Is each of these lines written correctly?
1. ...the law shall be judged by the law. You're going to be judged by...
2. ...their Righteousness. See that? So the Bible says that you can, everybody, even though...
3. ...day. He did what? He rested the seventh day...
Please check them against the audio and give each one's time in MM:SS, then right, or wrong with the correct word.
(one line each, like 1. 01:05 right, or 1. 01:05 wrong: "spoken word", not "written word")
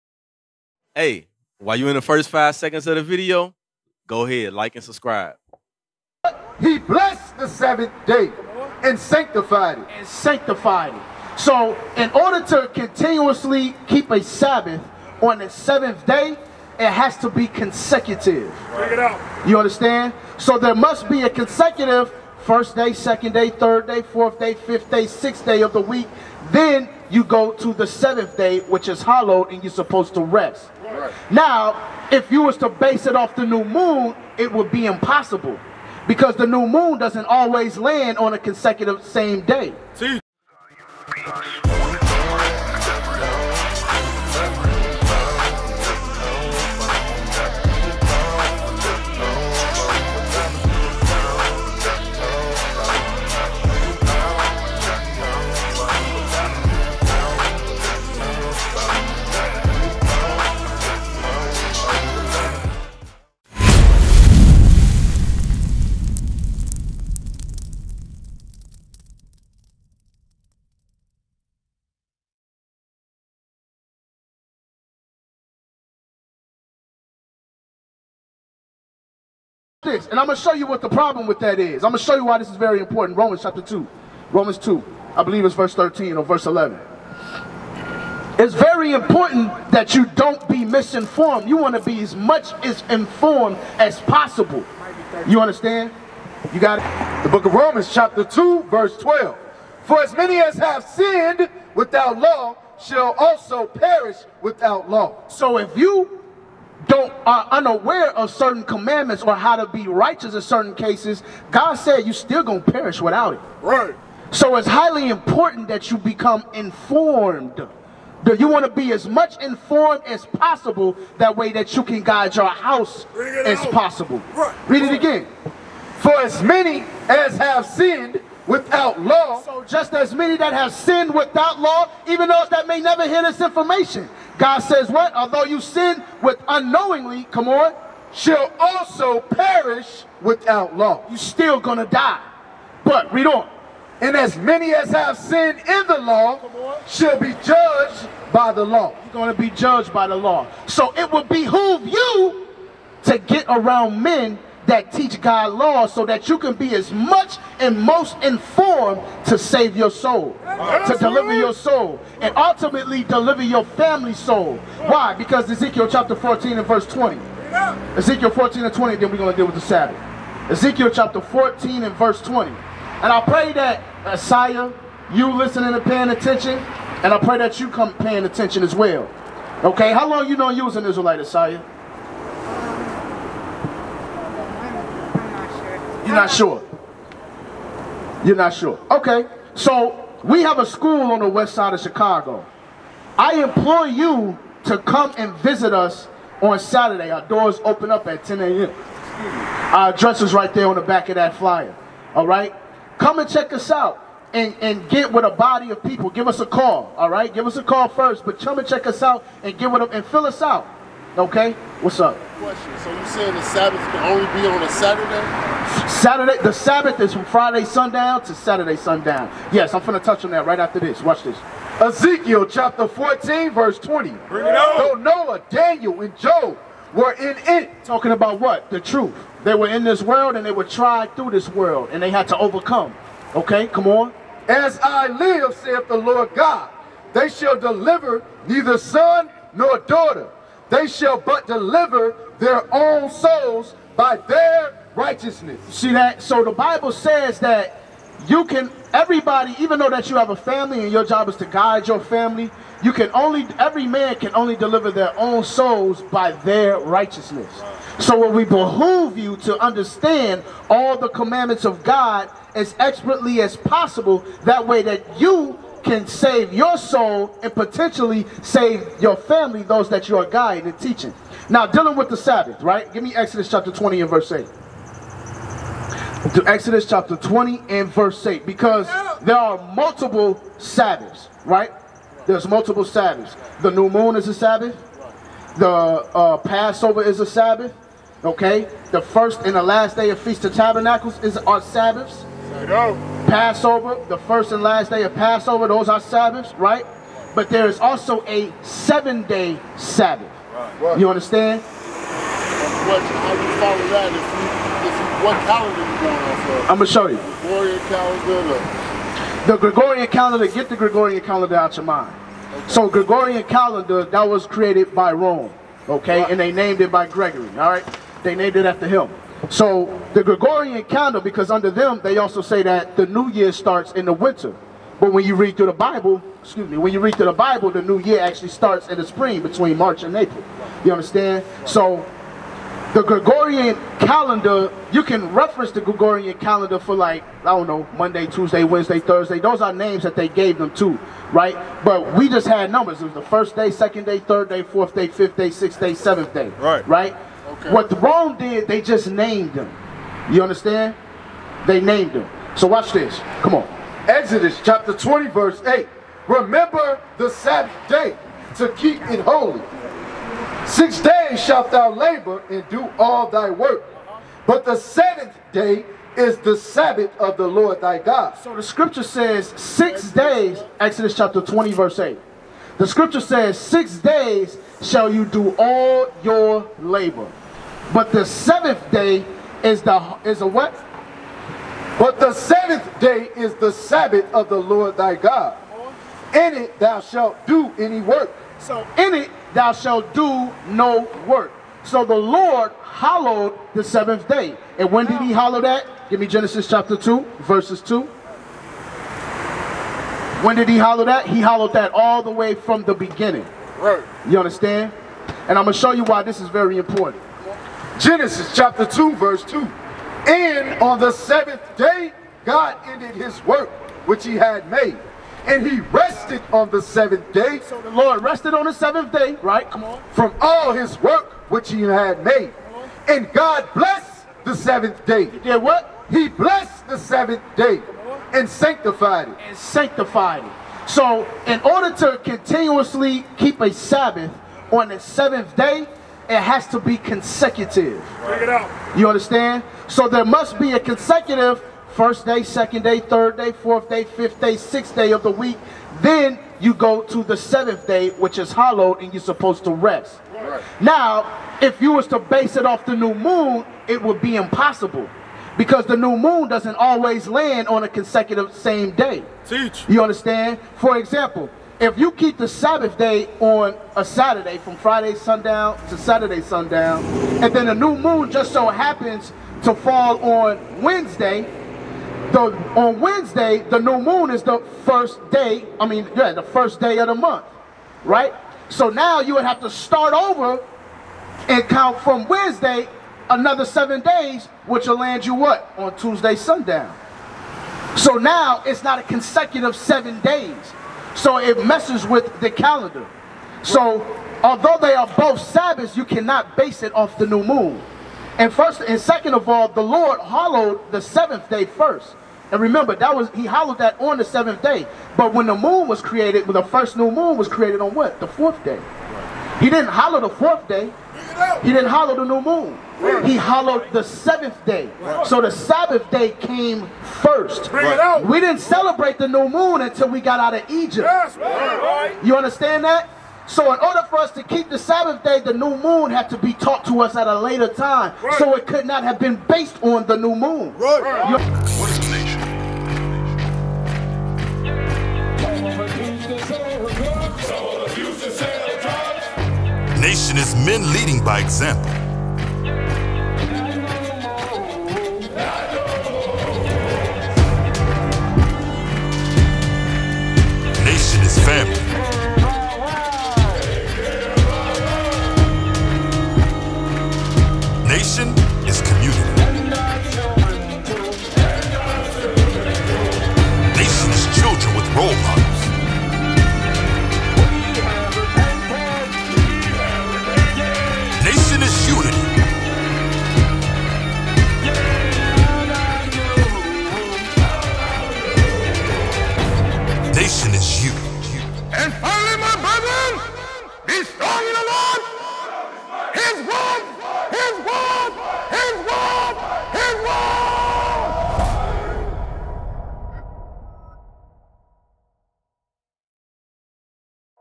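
1. 02:25 right
2. 04:04 right
3. 07:05 wrong: "blessed", not "rested".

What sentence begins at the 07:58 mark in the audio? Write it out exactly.
So now you would have to start over and count from Wednesday another seven days, which will land you what?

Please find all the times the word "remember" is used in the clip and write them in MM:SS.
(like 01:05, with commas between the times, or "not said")
05:56, 08:22.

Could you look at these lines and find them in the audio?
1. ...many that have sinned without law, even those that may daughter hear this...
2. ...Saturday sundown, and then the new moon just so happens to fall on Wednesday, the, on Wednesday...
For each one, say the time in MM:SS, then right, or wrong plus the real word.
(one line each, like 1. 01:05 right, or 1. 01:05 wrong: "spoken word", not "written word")
1. 02:10 wrong: "never", not "daughter"
2. 07:45 right.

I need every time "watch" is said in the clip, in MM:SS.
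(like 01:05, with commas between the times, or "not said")
03:41, 05:52.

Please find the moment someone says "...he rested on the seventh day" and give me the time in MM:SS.
06:55.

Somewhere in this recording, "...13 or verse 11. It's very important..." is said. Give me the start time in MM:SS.
01:25.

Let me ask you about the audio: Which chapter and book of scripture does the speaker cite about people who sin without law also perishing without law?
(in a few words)
Romans 2.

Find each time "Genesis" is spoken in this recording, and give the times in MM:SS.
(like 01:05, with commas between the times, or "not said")
06:36, 06:47.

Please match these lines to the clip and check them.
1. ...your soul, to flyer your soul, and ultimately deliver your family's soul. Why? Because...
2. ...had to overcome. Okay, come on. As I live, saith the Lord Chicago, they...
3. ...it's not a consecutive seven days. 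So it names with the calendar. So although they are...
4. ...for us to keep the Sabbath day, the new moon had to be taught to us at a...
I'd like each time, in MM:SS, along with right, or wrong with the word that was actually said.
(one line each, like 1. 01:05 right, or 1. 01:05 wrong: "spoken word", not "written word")
1. 02:39 wrong: "deliver", not "flyer"
2. 03:52 wrong: "God", not "Chicago"
3. 08:08 wrong: "messes", not "names"
4. 08:44 right.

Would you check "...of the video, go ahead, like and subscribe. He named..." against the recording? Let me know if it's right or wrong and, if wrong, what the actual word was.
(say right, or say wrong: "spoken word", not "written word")
wrong: "blessed", not "named".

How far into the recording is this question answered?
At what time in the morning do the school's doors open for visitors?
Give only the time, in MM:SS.
03:18.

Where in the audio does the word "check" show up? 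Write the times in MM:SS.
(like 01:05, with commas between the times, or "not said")
00:18, 03:23, 03:28, 07:18.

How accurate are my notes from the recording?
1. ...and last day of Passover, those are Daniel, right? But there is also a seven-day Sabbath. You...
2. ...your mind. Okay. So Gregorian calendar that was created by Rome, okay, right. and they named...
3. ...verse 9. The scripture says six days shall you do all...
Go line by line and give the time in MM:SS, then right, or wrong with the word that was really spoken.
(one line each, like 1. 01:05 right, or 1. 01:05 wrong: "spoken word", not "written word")
1. 04:54 wrong: "Sabbaths", not "Daniel"
2. 05:11 right
3. 06:11 wrong: "8", not "9".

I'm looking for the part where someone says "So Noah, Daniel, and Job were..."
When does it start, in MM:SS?
03:44.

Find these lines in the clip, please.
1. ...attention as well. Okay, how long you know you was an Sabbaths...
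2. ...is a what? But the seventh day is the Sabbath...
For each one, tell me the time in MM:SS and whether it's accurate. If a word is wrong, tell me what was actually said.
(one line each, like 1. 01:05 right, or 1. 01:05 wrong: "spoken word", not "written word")
1. 02:58 wrong: "Israelite", not "Sabbaths"
2. 06:20 right.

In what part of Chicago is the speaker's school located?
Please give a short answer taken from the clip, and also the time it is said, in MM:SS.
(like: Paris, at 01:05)
West side, at 03:11.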